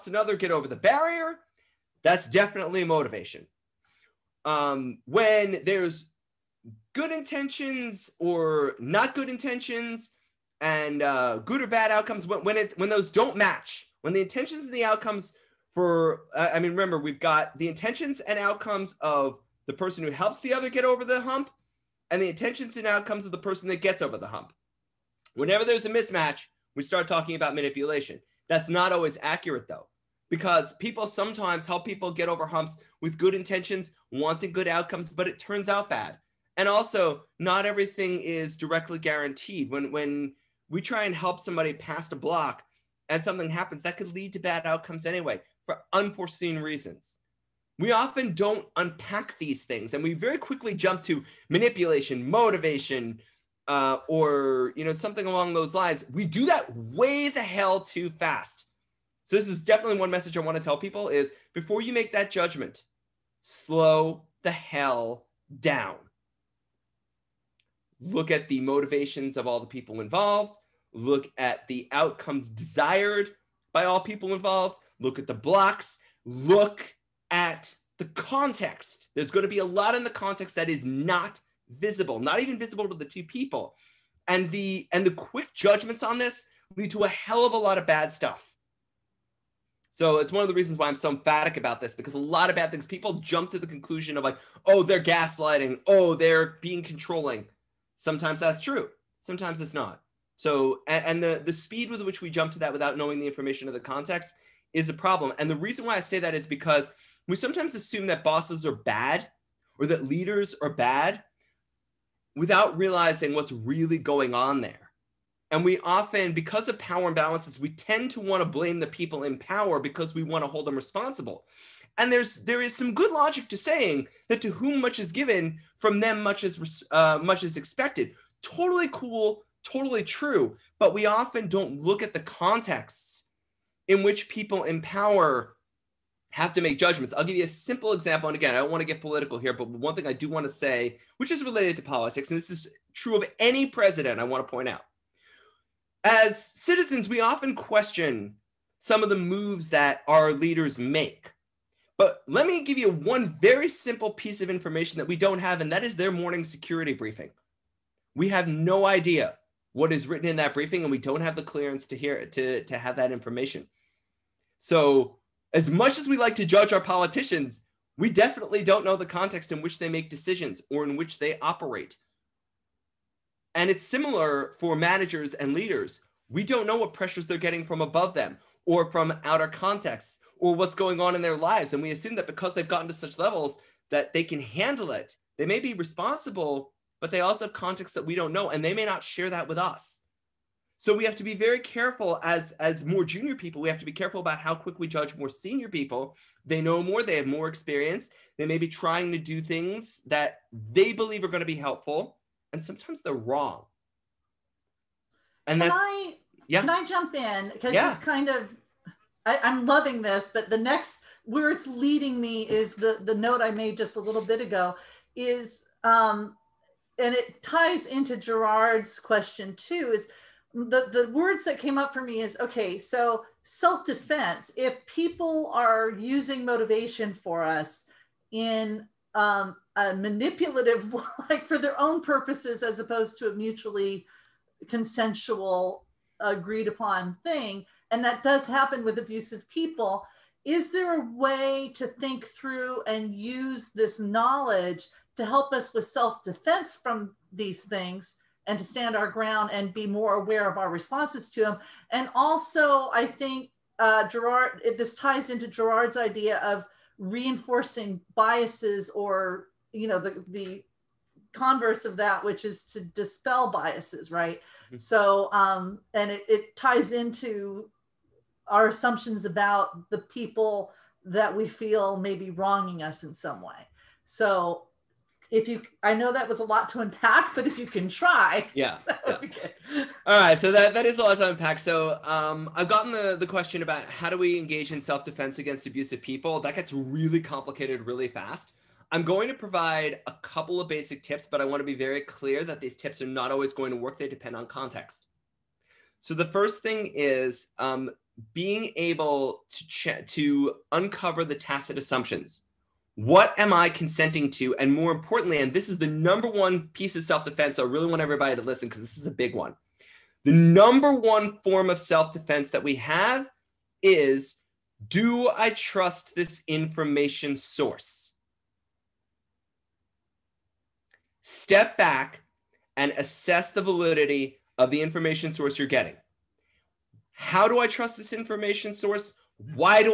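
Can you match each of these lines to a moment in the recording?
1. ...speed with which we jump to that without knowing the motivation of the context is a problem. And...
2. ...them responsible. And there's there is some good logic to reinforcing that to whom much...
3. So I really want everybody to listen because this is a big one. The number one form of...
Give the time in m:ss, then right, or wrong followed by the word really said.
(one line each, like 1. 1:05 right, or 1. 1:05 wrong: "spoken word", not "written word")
1. 1:41 wrong: "information", not "motivation"
2. 2:00 wrong: "saying", not "reinforcing"
3. 5:07 right.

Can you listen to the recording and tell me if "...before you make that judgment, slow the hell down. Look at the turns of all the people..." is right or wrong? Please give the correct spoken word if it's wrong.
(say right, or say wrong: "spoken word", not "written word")
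wrong: "motivations", not "turns".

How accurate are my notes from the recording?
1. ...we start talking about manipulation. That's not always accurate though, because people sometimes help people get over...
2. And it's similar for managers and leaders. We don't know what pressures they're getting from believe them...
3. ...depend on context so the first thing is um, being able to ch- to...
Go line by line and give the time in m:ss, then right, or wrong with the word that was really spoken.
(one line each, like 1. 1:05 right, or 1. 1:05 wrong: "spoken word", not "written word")
1. 0:26 right
2. 2:53 wrong: "above", not "believe"
3. 4:54 right.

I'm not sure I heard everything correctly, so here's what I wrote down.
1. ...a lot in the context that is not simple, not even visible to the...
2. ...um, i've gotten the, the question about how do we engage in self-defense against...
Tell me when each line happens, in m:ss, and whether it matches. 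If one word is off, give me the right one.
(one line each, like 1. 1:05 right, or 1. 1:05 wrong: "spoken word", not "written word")
1. 1:19 wrong: "visible", not "simple"
2. 4:42 right.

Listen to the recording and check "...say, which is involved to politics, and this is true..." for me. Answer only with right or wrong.
wrong.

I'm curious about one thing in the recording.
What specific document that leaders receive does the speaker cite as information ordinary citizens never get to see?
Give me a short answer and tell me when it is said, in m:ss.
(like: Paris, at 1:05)
morning security briefing, at 2:36.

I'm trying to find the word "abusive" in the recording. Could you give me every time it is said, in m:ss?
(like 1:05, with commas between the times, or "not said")
3:58, 4:45.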